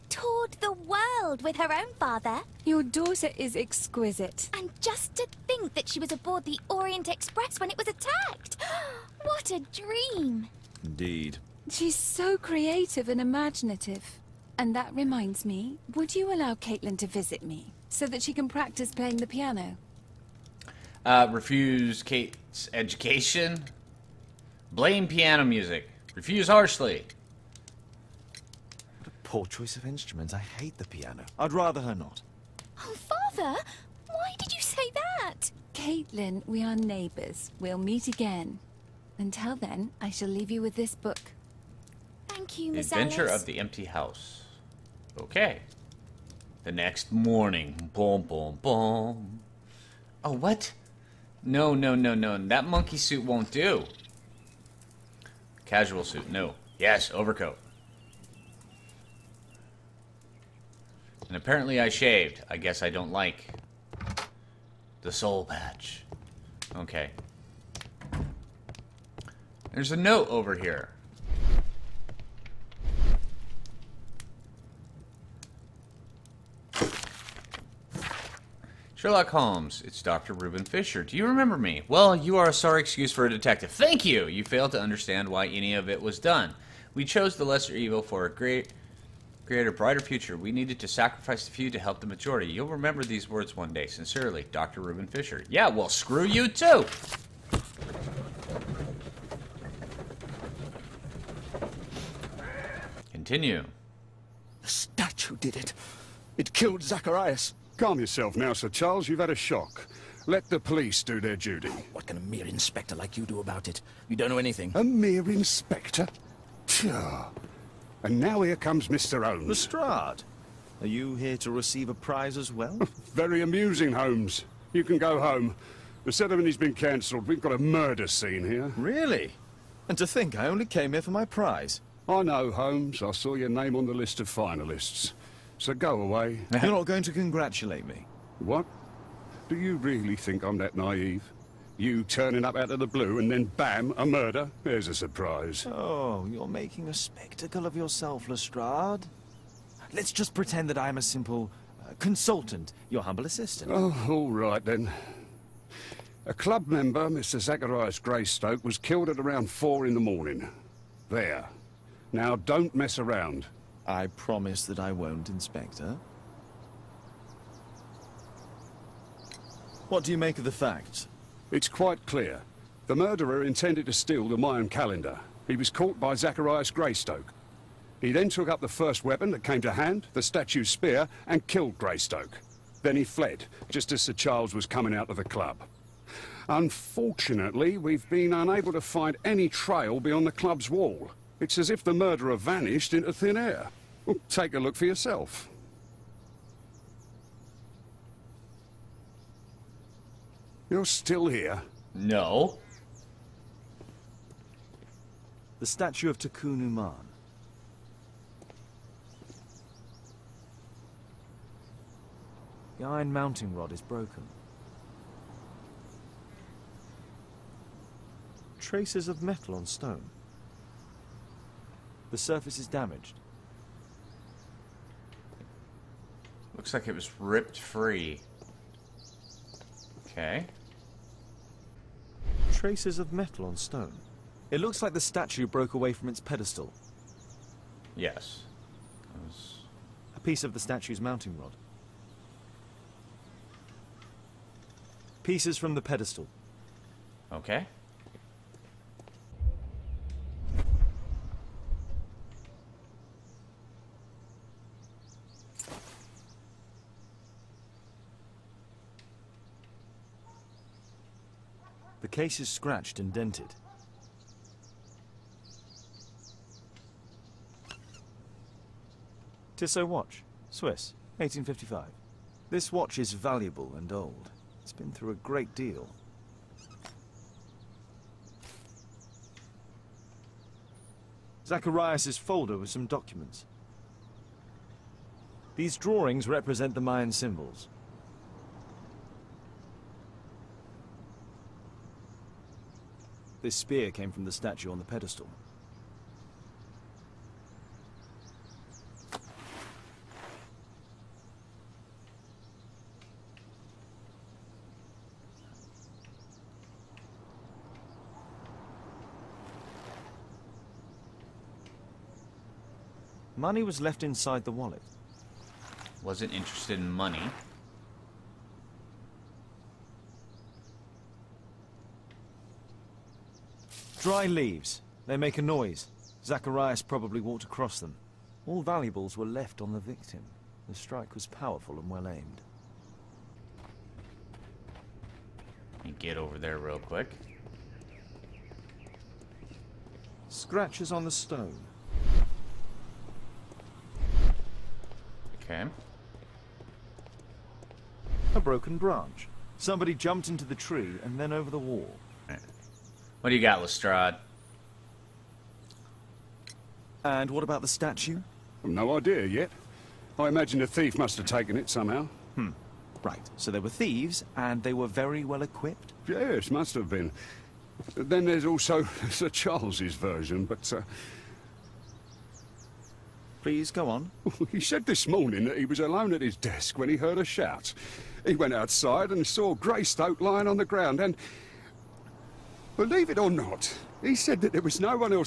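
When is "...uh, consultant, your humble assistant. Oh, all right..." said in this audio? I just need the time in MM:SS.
02:31.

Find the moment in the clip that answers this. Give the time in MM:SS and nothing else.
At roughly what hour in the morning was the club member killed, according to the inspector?
02:39.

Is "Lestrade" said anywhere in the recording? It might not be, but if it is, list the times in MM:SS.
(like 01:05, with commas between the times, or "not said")
01:59, 02:28, 05:53.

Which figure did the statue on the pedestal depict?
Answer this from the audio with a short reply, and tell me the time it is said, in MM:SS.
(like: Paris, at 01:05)
Tekun Uman, at 03:26.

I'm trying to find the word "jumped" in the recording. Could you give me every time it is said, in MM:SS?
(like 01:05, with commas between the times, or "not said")
05:49.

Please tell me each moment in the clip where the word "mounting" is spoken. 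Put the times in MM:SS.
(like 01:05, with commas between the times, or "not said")
03:33, 04:01.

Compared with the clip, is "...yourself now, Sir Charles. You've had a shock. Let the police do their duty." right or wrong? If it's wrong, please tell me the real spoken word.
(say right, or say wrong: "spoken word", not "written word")
right.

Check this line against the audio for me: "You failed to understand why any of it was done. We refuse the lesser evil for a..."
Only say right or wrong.
wrong.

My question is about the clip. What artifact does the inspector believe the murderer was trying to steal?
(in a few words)
Mayan calendar.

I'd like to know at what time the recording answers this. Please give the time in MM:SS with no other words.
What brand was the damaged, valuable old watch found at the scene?
04:29.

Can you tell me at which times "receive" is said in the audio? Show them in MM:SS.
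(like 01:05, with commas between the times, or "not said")
02:01.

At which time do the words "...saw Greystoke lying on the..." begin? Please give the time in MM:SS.
06:19.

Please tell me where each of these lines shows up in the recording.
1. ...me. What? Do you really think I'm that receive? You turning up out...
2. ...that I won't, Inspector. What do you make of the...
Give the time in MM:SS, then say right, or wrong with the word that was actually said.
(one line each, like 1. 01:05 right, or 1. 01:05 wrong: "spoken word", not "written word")
1. 02:17 wrong: "naive", not "receive"
2. 02:44 right.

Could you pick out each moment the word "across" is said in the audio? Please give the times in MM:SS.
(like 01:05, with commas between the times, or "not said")
05:27.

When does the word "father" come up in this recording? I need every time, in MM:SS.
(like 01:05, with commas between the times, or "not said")
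00:01, 00:32.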